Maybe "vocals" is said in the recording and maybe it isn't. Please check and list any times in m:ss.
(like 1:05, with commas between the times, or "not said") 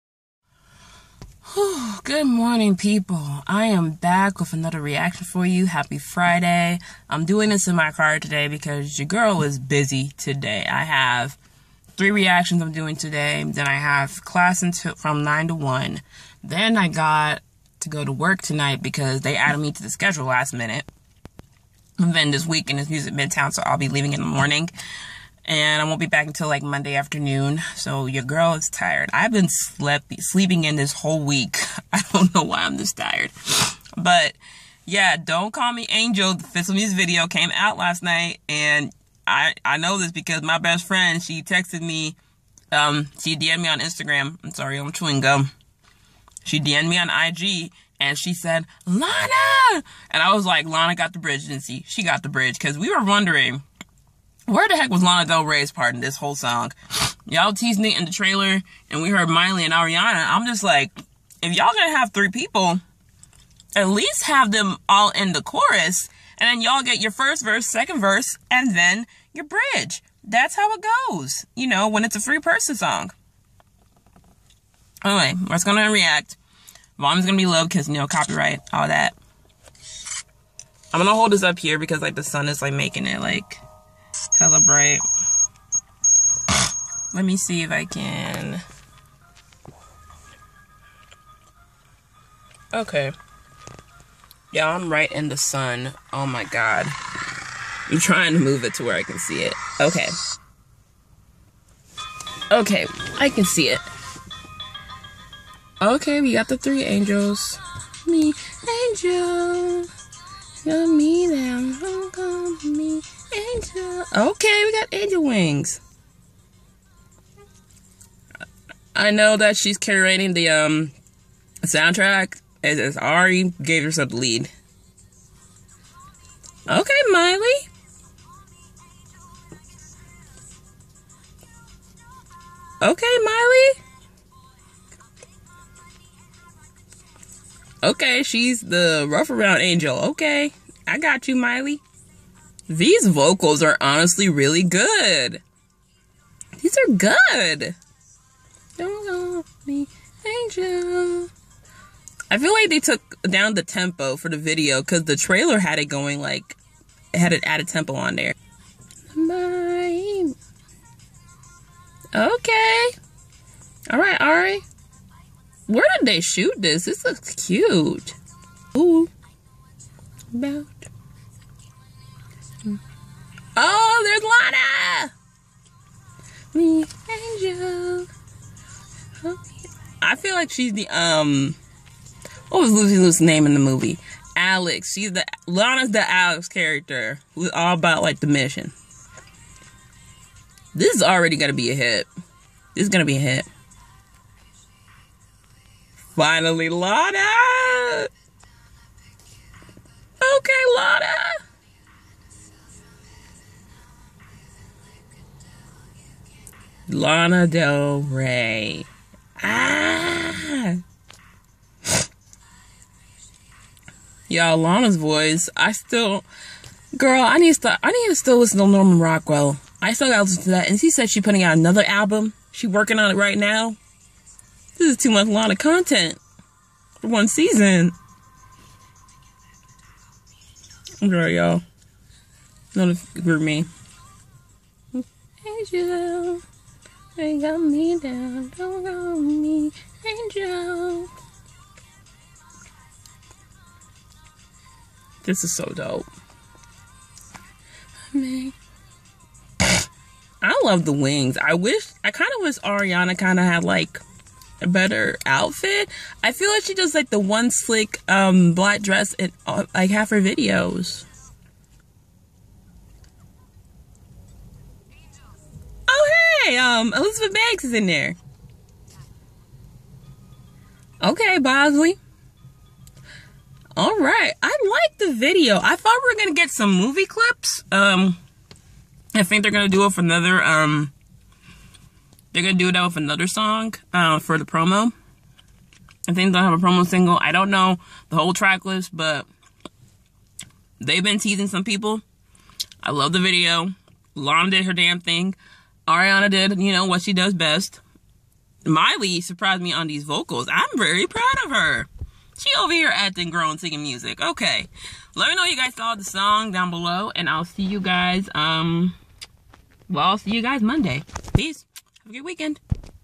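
2:23, 5:00.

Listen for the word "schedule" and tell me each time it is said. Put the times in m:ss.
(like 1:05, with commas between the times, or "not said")
0:19.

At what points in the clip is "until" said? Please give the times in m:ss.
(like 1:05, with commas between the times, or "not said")
0:14, 0:26.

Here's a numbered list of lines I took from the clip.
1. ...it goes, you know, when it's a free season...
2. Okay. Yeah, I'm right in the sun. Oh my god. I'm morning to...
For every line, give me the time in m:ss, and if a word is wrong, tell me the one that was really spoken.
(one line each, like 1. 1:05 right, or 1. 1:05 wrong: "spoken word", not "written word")
1. 1:10 wrong: "person", not "season"
2. 1:32 wrong: "trying", not "morning".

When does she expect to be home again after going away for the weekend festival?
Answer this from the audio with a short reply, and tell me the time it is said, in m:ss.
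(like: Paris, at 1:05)
Monday afternoon, at 0:26.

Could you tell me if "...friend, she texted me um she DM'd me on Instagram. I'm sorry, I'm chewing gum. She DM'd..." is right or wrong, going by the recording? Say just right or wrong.
right.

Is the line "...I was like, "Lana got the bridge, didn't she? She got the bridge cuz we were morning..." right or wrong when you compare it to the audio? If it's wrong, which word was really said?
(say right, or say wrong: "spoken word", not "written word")
wrong: "wondering", not "morning".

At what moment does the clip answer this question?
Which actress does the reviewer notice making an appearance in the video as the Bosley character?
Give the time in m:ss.
4:26.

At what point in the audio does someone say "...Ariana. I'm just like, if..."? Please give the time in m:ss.
0:59.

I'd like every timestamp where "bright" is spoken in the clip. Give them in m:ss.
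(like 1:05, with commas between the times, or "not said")
1:24.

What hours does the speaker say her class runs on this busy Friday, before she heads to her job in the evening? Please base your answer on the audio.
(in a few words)
9 to 1.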